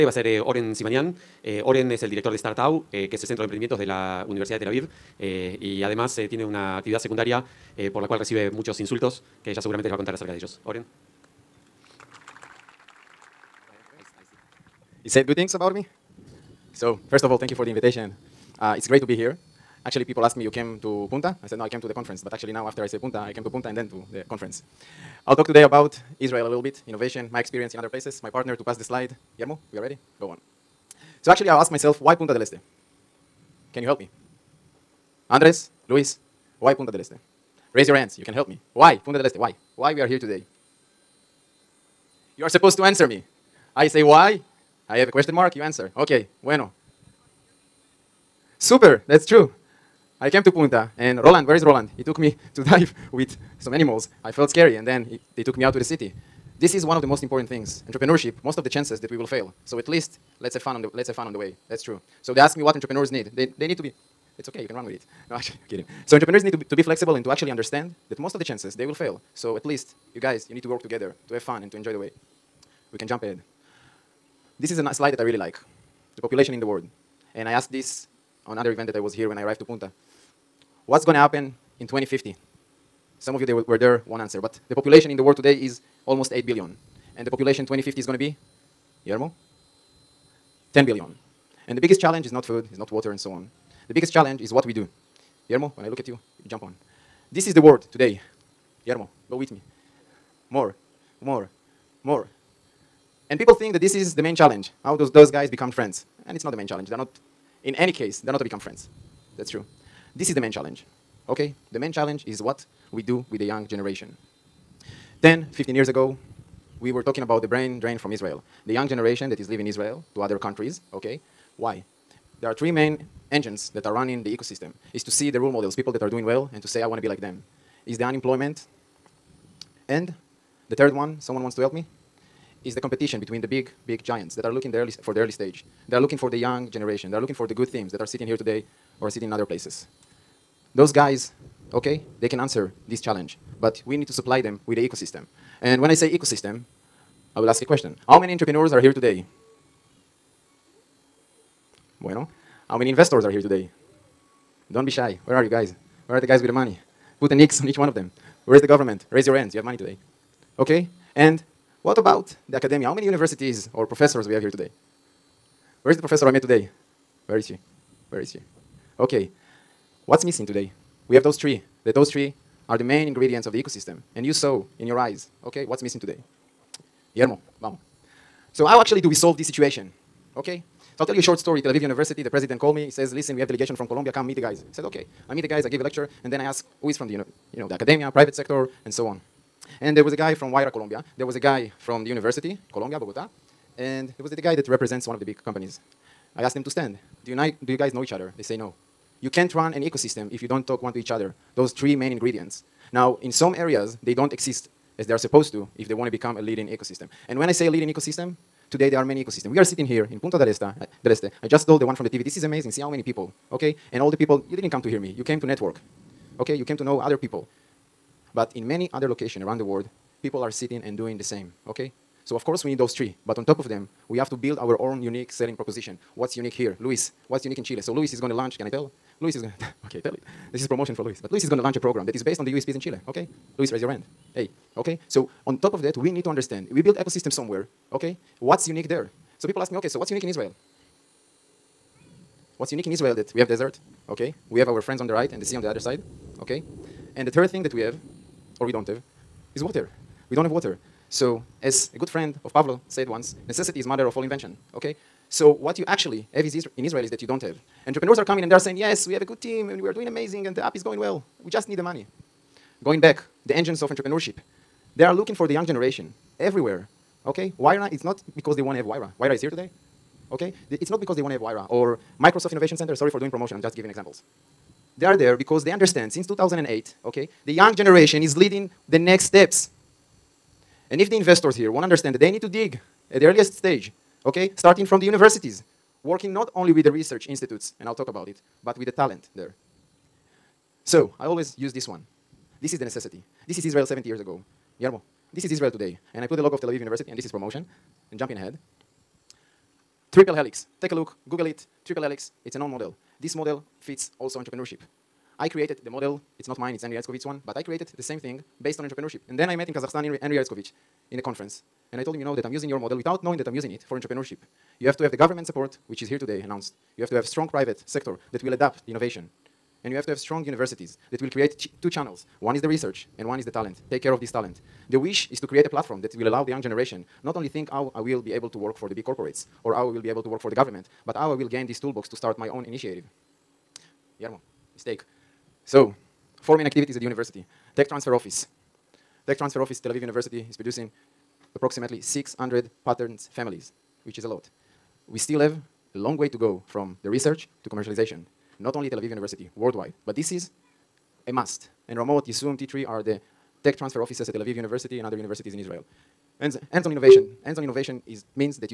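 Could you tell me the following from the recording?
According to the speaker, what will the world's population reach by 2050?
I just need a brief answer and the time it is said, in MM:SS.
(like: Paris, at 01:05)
10 billion, at 01:30.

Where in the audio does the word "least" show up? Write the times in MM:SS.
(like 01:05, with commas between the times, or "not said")
00:59, 01:09.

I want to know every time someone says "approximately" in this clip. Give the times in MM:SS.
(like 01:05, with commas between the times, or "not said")
05:41.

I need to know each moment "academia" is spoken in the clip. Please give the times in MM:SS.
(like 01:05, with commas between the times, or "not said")
02:42, 03:07.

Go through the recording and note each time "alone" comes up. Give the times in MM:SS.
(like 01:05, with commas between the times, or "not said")
not said.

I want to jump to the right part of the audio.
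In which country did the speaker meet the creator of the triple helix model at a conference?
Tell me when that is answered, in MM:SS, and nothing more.
05:09.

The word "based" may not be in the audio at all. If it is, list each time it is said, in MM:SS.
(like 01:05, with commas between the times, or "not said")
03:52, 05:08.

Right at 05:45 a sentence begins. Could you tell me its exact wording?
We still have a long way to go from the research to commercialization.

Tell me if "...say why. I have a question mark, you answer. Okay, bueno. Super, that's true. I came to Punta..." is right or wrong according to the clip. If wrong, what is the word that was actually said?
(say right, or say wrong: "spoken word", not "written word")
right.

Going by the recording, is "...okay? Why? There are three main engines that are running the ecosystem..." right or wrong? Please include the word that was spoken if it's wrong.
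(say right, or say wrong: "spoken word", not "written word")
right.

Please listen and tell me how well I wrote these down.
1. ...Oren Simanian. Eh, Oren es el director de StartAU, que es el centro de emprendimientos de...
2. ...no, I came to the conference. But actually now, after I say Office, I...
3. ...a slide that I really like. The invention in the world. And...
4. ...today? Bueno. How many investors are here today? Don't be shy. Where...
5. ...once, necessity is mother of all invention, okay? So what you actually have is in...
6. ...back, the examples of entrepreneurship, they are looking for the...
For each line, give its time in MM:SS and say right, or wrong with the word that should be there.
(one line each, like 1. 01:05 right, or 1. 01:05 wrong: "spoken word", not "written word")
1. 00:00 right
2. 00:21 wrong: "Punta", not "Office"
3. 01:14 wrong: "population", not "invention"
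4. 02:28 right
5. 04:13 right
6. 04:23 wrong: "engines", not "examples".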